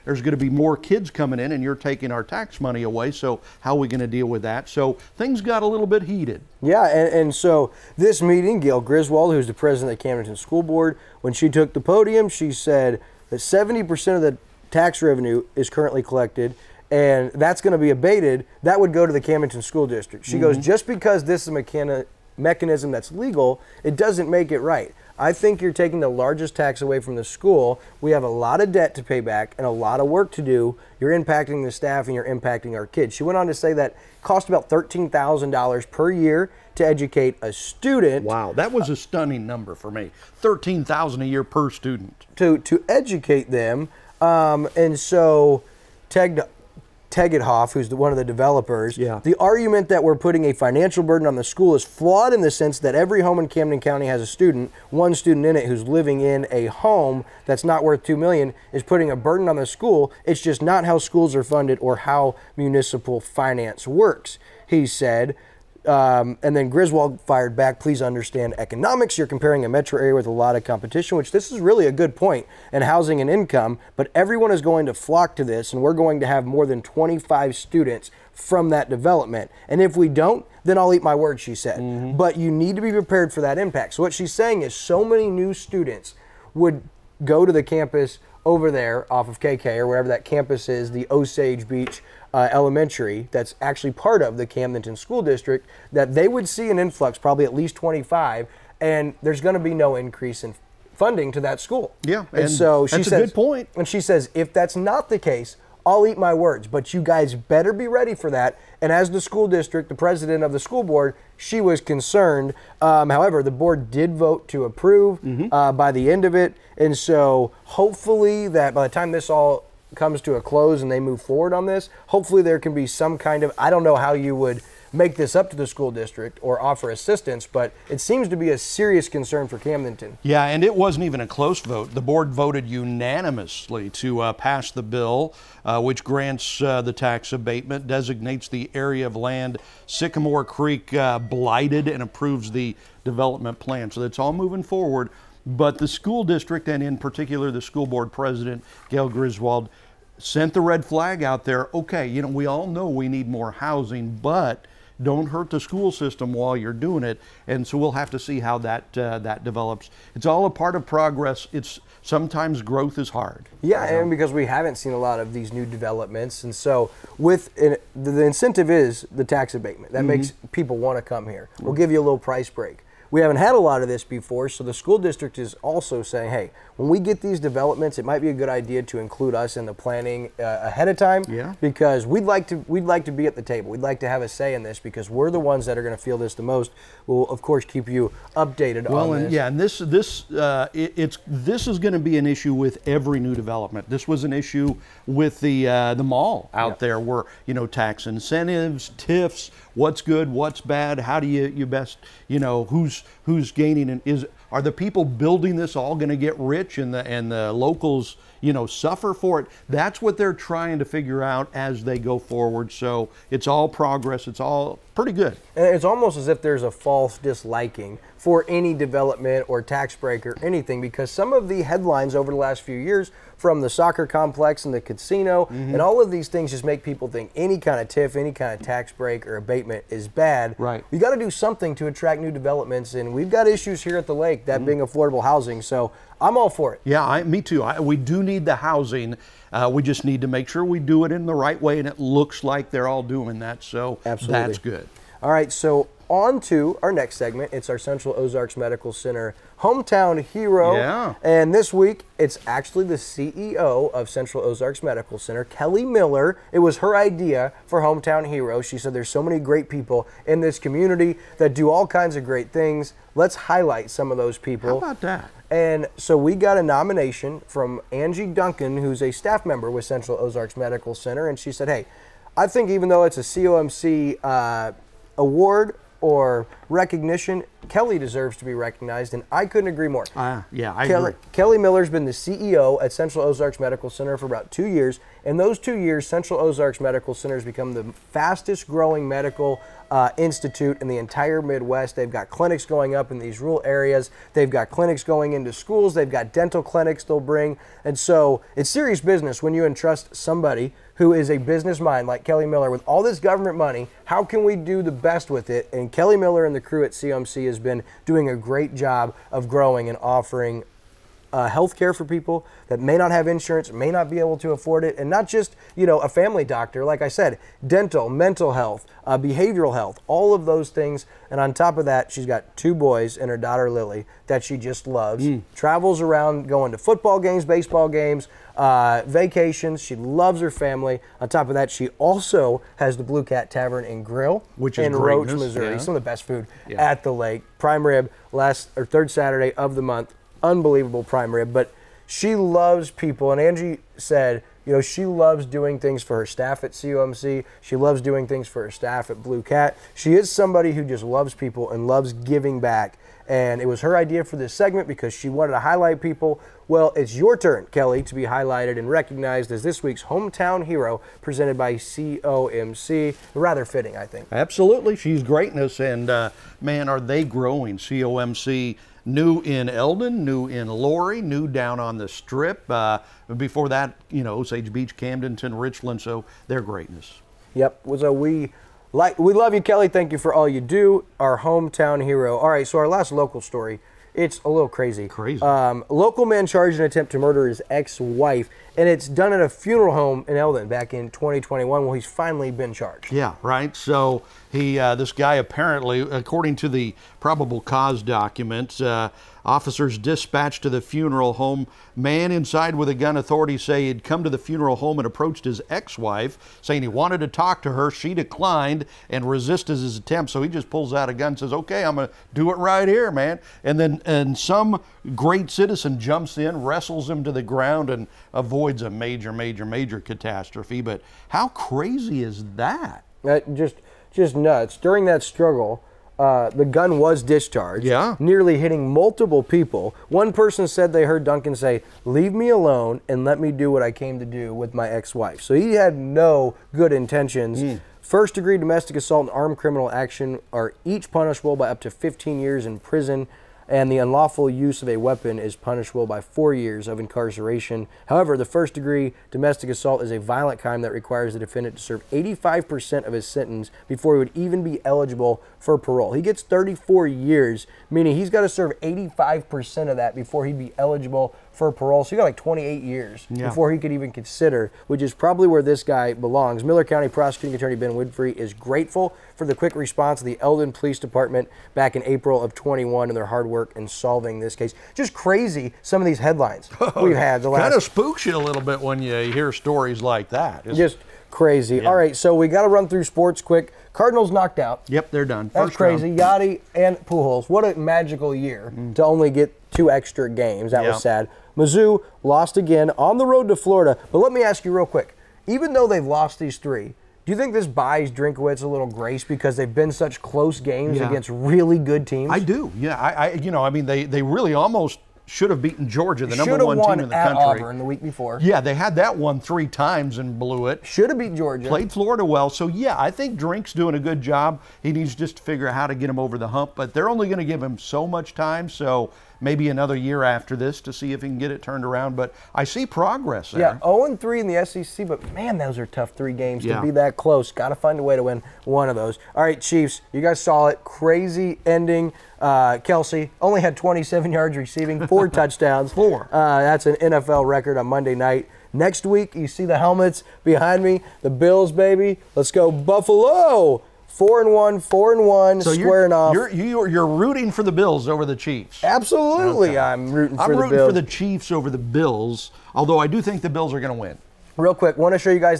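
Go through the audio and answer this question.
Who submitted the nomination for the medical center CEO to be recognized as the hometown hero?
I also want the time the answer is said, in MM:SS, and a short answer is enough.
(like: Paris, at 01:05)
Angie Duncan, at 04:27.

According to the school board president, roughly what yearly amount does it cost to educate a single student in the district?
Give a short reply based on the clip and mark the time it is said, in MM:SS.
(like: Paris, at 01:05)
$13,000, at 00:34.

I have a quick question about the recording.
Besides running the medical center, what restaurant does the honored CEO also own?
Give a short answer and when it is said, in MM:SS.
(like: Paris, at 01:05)
Blue Cat Tavern and Grill, at 05:33.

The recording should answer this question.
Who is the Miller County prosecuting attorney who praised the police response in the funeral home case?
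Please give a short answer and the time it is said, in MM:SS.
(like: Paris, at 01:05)
Ben Winfrey, at 07:47.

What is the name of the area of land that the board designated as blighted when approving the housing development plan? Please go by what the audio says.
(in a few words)
Sycamore Creek.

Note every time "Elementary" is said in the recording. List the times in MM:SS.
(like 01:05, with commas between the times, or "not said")
01:32.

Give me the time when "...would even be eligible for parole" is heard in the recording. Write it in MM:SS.
07:34.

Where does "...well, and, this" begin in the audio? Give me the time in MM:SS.
03:08.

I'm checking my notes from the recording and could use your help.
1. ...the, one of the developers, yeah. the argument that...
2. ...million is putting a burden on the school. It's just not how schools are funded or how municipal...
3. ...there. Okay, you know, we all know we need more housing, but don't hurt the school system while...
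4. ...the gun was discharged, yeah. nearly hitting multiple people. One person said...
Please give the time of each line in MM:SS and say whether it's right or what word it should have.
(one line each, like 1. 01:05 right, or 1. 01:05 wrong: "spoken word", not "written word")
1. 00:47 right
2. 00:58 right
3. 02:31 right
4. 07:06 right.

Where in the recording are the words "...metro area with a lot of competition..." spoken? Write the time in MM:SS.
01:09.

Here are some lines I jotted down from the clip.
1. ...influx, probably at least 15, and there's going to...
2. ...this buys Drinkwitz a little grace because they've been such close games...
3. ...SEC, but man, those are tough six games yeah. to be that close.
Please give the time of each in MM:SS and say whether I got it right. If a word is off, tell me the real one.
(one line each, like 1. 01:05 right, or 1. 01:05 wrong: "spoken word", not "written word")
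1. 01:36 wrong: "25", not "15"
2. 08:17 right
3. 08:44 wrong: "three", not "six".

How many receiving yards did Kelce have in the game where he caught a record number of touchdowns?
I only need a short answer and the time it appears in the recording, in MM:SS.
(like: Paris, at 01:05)
27, at 08:53.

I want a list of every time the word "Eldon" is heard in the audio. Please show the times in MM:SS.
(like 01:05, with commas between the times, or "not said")
06:09, 06:30, 07:50.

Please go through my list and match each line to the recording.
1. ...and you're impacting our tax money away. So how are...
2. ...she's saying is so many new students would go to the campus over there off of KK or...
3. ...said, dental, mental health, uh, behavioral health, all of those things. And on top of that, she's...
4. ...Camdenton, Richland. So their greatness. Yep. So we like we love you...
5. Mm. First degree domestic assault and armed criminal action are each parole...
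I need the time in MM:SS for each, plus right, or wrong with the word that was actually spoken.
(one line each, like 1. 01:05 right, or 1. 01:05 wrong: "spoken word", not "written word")
1. 00:01 wrong: "taking", not "impacting"
2. 01:24 right
3. 05:17 right
4. 06:14 right
5. 07:17 wrong: "punishable", not "parole".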